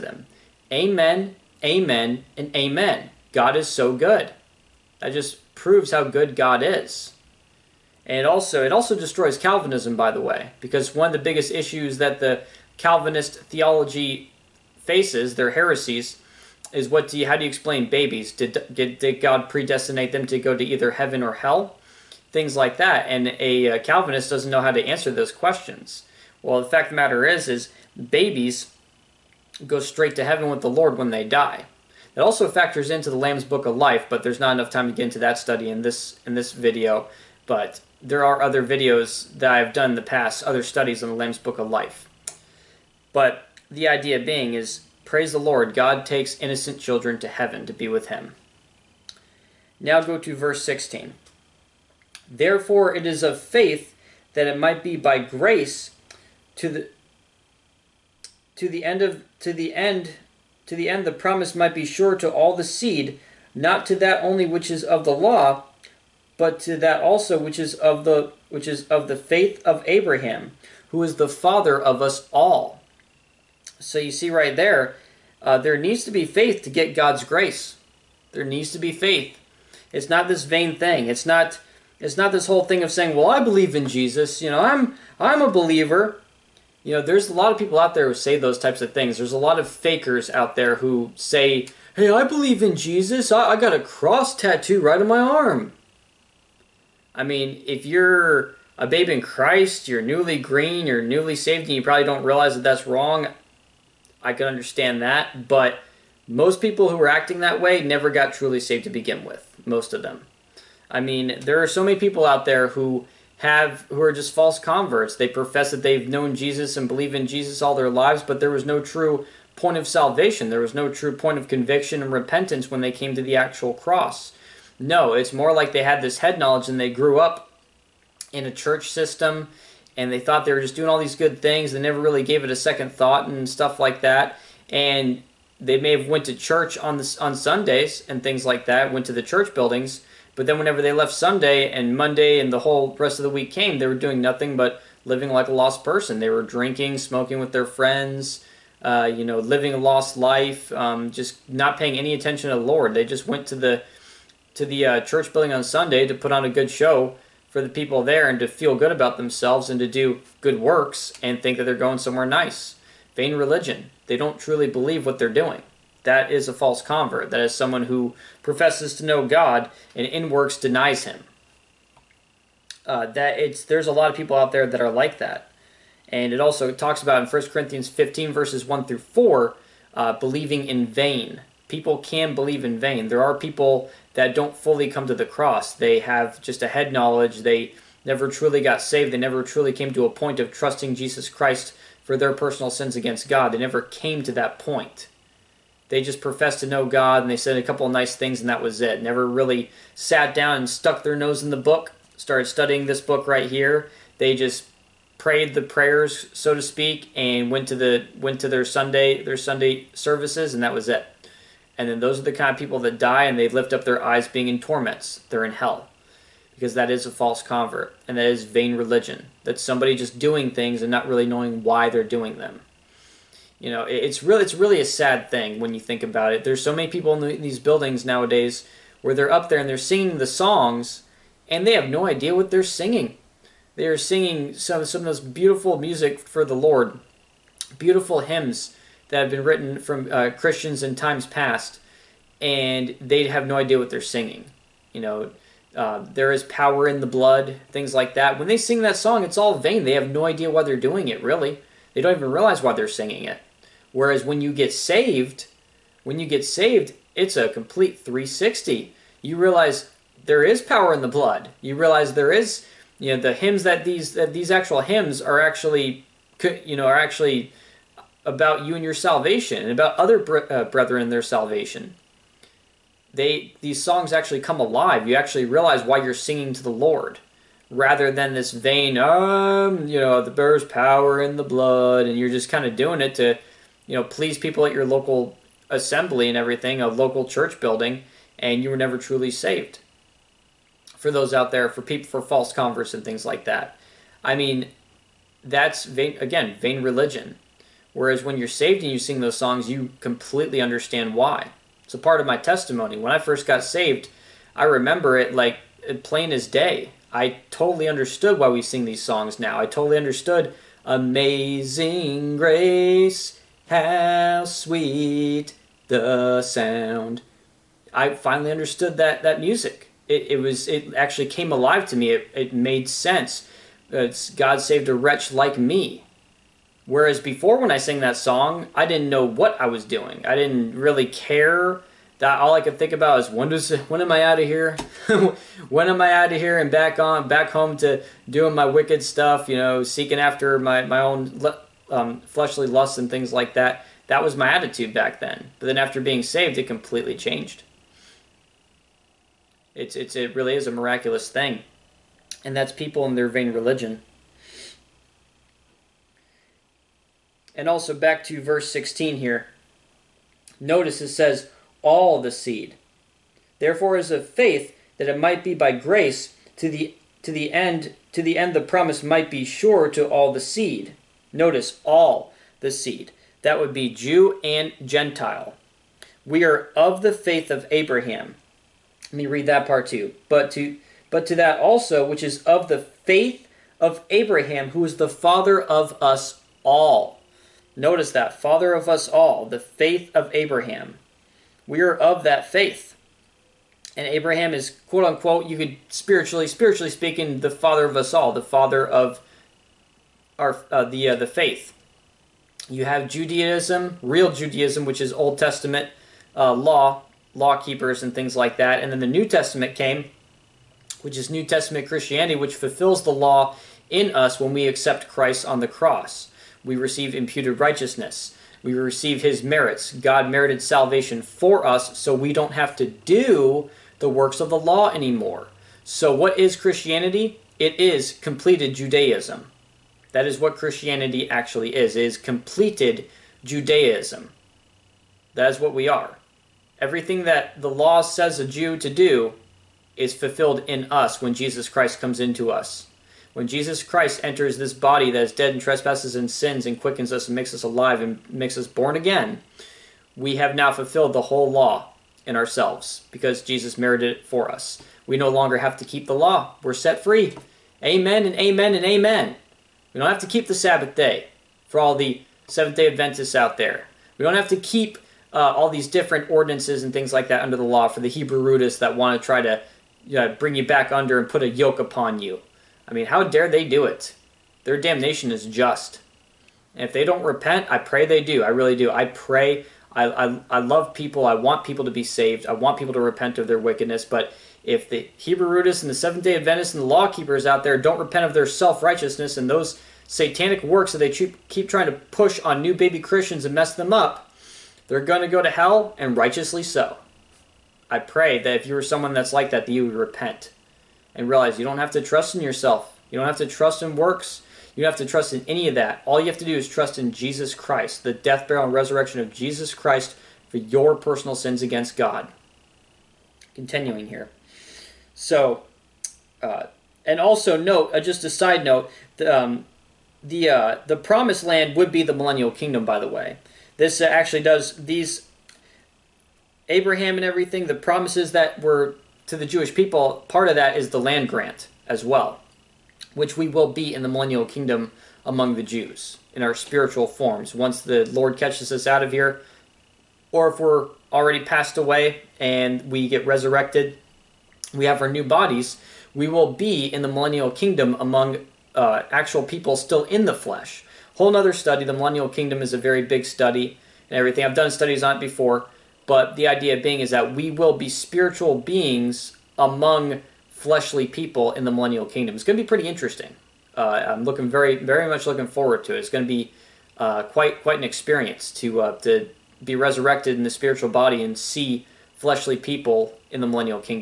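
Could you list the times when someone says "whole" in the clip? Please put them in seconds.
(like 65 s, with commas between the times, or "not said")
82 s, 142 s, 451 s, 551 s.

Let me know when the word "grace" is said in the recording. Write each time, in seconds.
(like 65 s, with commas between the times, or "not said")
55 s, 77 s, 312 s, 365 s.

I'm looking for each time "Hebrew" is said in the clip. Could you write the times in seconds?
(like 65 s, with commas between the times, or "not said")
468 s, 485 s.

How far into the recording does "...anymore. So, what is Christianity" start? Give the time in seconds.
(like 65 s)
424 s.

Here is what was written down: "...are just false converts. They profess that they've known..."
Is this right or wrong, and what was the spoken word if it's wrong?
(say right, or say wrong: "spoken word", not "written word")
right.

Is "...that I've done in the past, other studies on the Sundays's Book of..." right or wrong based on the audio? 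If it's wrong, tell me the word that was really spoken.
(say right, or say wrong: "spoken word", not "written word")
wrong: "Lamb", not "Sundays".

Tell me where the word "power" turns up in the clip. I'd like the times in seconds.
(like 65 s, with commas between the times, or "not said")
246 s, 260 s, 280 s.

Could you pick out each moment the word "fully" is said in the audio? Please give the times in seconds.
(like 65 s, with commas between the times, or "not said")
184 s.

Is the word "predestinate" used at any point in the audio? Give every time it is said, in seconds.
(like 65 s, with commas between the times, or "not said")
19 s.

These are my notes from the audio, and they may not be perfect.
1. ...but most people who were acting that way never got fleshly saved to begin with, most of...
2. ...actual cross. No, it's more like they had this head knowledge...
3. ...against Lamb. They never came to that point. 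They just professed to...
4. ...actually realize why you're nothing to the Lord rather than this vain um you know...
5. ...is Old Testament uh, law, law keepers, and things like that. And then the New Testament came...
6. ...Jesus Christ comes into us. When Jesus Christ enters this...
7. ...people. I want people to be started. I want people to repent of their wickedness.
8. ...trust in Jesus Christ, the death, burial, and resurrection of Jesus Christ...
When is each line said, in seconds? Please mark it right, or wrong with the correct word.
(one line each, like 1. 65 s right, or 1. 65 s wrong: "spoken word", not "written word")
1. 105 s wrong: "truly", not "fleshly"
2. 123 s right
3. 192 s wrong: "God", not "Lamb"
4. 275 s wrong: "singing", not "nothing"
5. 405 s right
6. 441 s right
7. 480 s wrong: "saved", not "started"
8. 506 s right.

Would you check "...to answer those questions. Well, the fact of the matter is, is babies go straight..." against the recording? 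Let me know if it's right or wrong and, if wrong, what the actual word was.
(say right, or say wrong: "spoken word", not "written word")
right.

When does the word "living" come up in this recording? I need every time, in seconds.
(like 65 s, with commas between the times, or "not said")
145 s, 149 s.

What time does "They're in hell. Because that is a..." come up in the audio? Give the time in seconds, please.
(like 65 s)
215 s.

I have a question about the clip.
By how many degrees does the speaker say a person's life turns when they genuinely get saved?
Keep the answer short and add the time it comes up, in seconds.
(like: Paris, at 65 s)
360, at 257 s.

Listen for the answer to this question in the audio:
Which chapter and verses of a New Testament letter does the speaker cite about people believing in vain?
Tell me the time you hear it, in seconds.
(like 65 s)
177 s.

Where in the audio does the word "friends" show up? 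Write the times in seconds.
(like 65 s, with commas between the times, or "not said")
147 s.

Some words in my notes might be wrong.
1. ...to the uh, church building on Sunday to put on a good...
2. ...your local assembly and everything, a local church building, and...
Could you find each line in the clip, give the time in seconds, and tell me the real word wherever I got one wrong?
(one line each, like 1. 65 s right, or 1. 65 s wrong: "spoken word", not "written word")
1. 154 s right
2. 284 s right.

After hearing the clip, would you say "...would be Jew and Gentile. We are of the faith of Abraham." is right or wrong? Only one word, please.
right.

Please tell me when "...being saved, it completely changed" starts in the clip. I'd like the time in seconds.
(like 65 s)
345 s.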